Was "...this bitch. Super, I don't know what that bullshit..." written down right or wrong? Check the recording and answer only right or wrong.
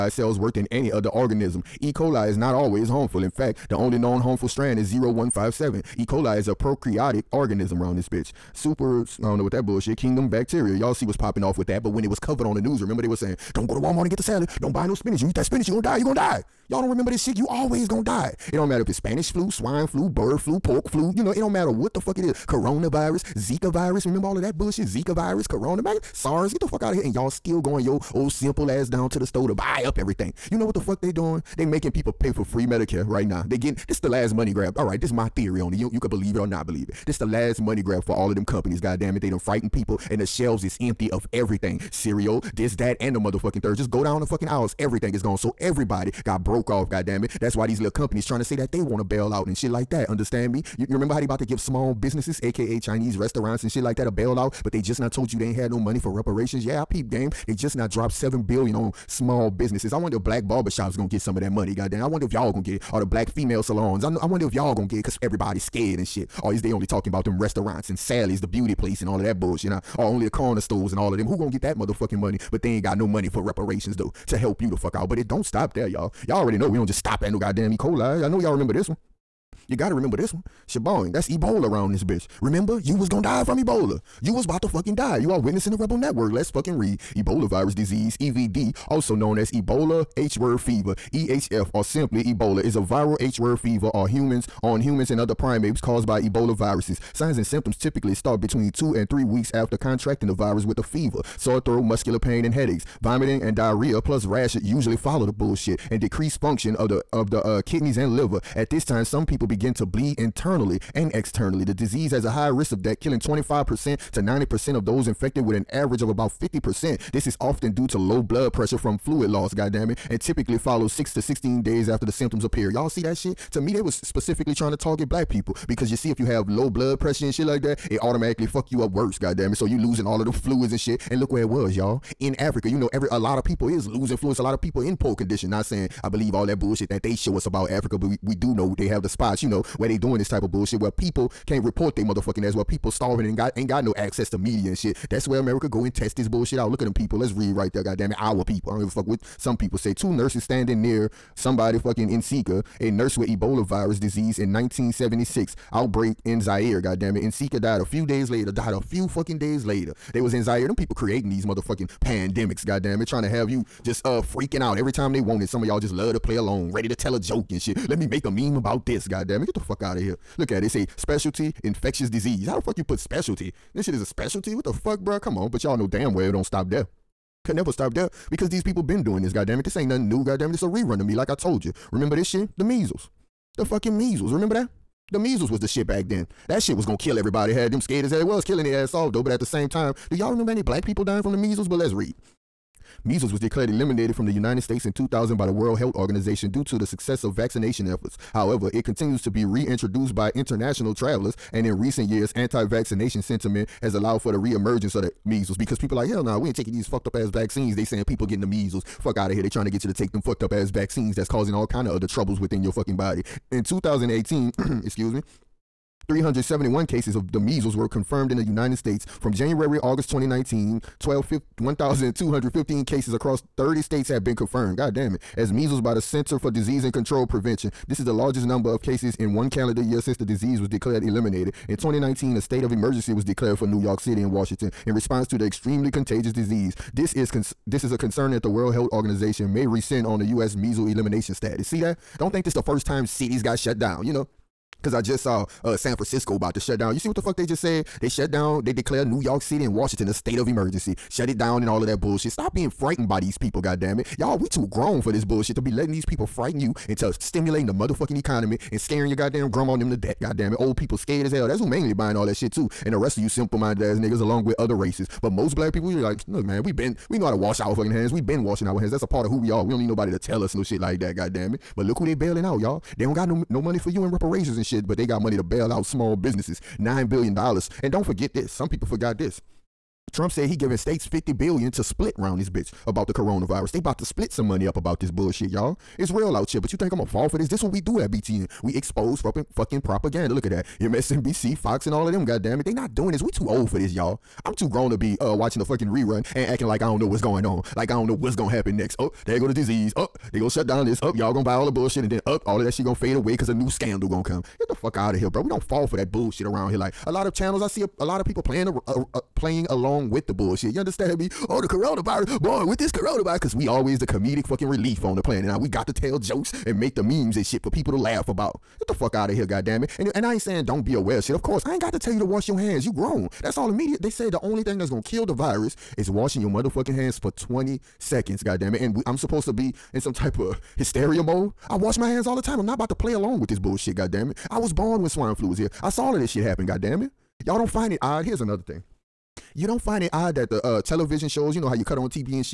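right.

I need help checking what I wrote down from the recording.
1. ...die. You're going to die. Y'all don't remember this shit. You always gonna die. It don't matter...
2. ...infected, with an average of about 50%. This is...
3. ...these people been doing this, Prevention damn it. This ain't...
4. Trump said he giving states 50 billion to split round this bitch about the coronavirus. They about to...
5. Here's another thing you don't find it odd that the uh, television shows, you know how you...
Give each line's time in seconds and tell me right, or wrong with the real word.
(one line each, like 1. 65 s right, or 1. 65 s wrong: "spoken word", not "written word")
1. 15 s right
2. 115 s right
3. 178 s wrong: "God", not "Prevention"
4. 280 s right
5. 338 s right.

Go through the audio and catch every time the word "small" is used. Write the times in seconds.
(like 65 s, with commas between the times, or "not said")
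51 s, 59 s, 275 s.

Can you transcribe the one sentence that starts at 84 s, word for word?
You was about to fucking die.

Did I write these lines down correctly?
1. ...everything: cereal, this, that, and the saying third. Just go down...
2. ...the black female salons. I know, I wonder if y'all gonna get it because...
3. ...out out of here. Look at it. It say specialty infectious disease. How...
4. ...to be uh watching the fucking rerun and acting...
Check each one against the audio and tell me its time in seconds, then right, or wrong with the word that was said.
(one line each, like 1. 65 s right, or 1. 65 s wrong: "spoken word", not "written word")
1. 41 s wrong: "motherfucking", not "saying"
2. 62 s right
3. 169 s right
4. 294 s right.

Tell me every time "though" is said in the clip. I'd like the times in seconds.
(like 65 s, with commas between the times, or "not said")
73 s, 189 s.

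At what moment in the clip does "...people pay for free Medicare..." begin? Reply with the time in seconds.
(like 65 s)
31 s.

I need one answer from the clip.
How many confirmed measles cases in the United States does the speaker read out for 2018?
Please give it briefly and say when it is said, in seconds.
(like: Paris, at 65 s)
371, at 216 s.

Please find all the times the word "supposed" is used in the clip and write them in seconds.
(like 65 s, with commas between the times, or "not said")
329 s.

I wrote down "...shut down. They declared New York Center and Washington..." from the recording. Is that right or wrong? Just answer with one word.
wrong.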